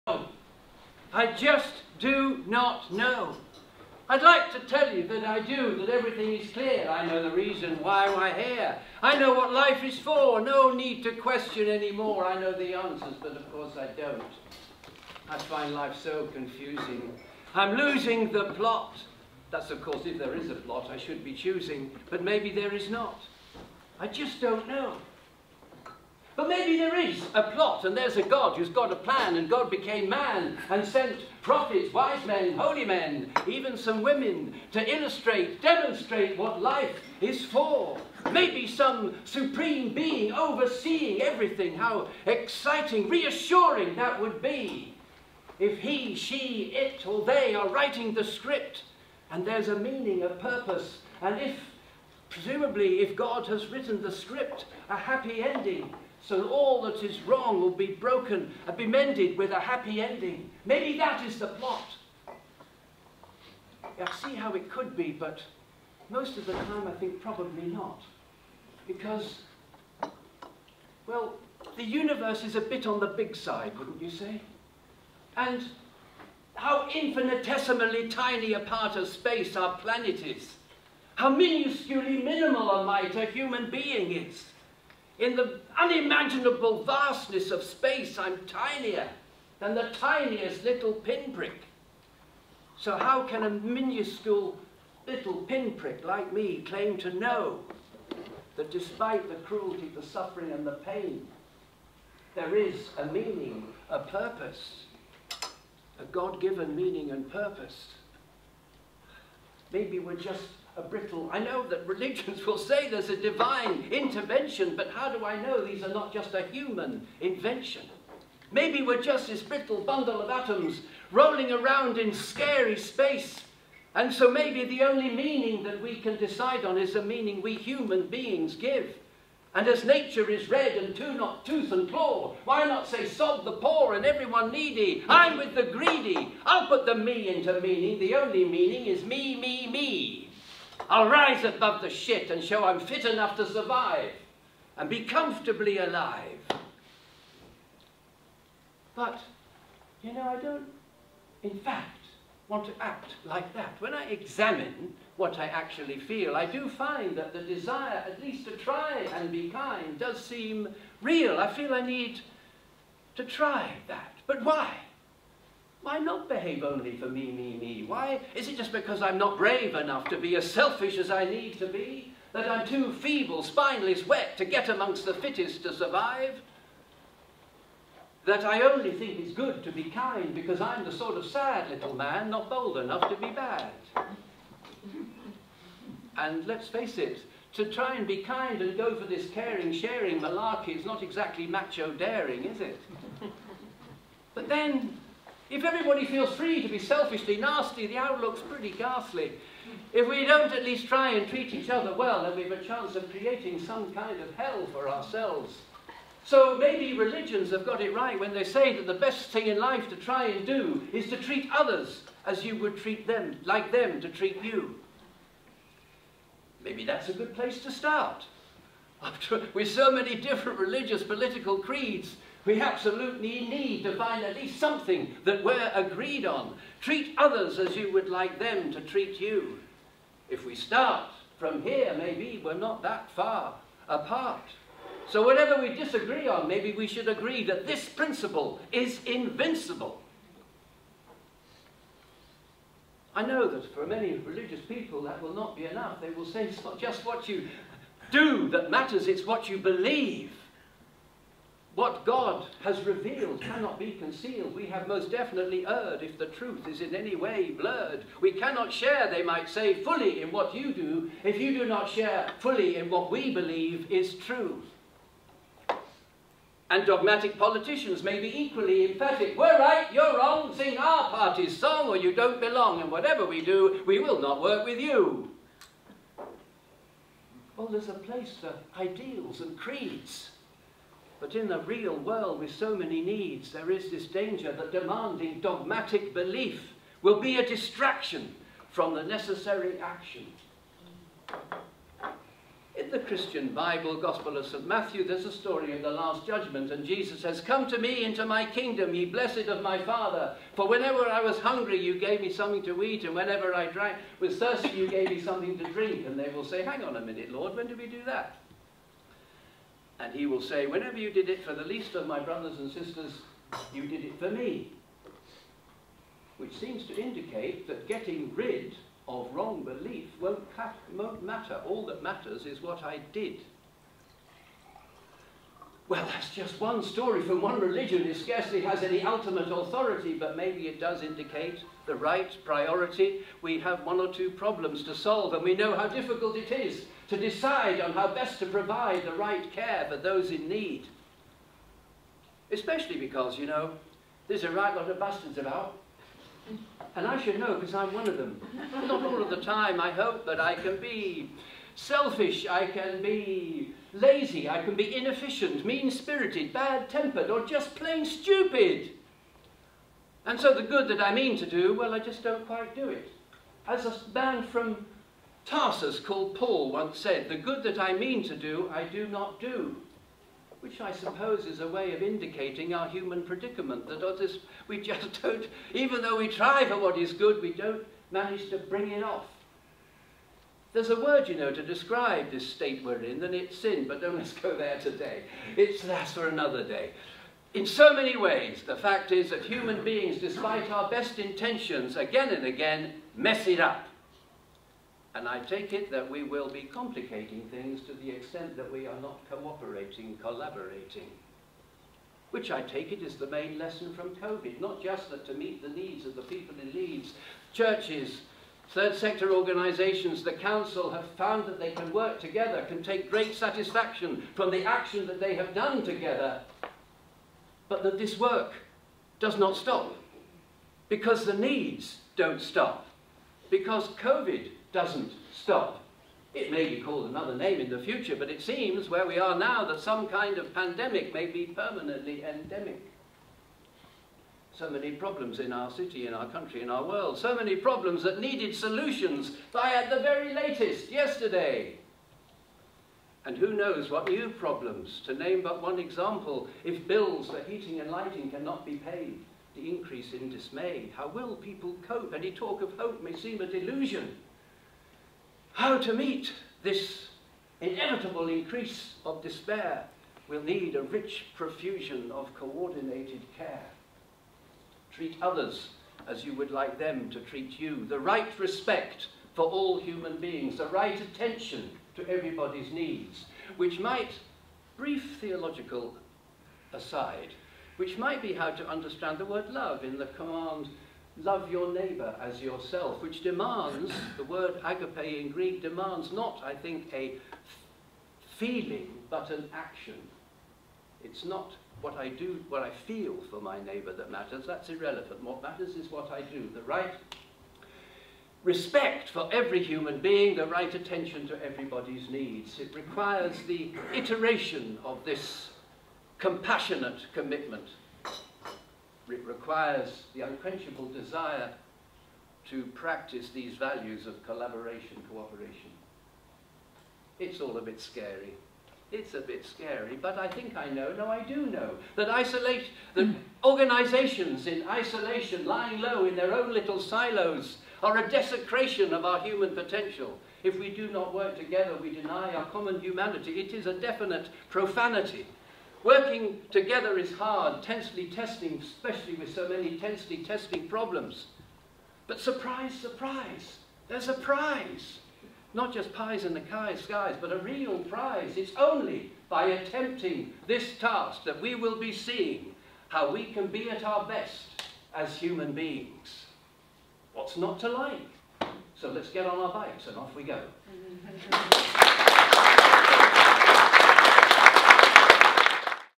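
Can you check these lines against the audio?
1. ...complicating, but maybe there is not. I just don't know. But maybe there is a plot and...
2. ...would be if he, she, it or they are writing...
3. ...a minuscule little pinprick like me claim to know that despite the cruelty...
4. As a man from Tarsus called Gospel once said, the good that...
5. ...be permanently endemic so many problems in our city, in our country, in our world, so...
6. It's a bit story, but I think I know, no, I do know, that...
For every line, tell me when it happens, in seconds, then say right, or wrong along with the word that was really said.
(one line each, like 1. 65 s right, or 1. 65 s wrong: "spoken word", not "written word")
1. 21 s wrong: "choosing", not "complicating"
2. 44 s right
3. 93 s right
4. 363 s wrong: "Paul", not "Gospel"
5. 431 s right
6. 518 s wrong: "scary", not "story".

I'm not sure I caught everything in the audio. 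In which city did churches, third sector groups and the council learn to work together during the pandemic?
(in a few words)
Leeds.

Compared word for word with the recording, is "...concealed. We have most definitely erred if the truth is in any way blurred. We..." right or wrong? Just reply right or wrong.
right.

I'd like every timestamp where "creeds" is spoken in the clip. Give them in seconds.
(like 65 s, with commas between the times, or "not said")
221 s, 279 s.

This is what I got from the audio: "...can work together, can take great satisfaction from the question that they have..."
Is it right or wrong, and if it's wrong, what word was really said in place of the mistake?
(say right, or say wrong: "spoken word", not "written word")
wrong: "action", not "question".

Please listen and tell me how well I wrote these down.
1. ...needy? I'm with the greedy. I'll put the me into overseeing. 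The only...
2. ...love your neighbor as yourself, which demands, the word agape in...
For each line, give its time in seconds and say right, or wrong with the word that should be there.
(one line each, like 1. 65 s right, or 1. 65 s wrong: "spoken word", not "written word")
1. 134 s wrong: "meaning", not "overseeing"
2. 481 s right.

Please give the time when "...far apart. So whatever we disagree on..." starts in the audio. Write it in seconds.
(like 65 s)
233 s.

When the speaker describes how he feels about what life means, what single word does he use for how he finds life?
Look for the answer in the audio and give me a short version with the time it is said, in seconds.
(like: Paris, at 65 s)
Confusing, at 16 s.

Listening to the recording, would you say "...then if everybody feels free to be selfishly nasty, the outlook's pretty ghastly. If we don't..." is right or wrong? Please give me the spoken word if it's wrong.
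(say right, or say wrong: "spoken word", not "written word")
right.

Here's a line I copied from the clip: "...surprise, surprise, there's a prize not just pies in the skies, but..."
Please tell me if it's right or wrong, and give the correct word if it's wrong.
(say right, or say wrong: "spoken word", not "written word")
right.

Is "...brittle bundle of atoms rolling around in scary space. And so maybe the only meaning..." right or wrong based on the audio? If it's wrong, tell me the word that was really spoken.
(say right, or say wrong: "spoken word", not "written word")
right.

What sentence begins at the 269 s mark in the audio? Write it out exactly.
We're right, you're wrong, sing our party's song or you don't belong, and whatever we do, we will not work with you.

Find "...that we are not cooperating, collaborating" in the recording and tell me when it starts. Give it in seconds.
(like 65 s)
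398 s.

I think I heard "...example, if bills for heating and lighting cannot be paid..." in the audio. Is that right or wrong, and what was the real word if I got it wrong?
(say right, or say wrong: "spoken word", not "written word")
right.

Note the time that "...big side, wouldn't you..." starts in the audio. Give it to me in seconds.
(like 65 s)
73 s.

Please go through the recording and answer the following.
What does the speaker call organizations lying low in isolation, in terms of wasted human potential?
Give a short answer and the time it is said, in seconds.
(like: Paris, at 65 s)
A desecration, at 527 s.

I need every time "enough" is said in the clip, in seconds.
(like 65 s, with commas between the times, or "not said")
143 s, 169 s, 182 s, 245 s.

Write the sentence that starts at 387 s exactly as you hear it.
In so many ways, the fact is that human beings, despite our best intentions, again and again, mess it up.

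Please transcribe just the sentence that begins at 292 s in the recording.
In the Christian Bible, Gospel of St.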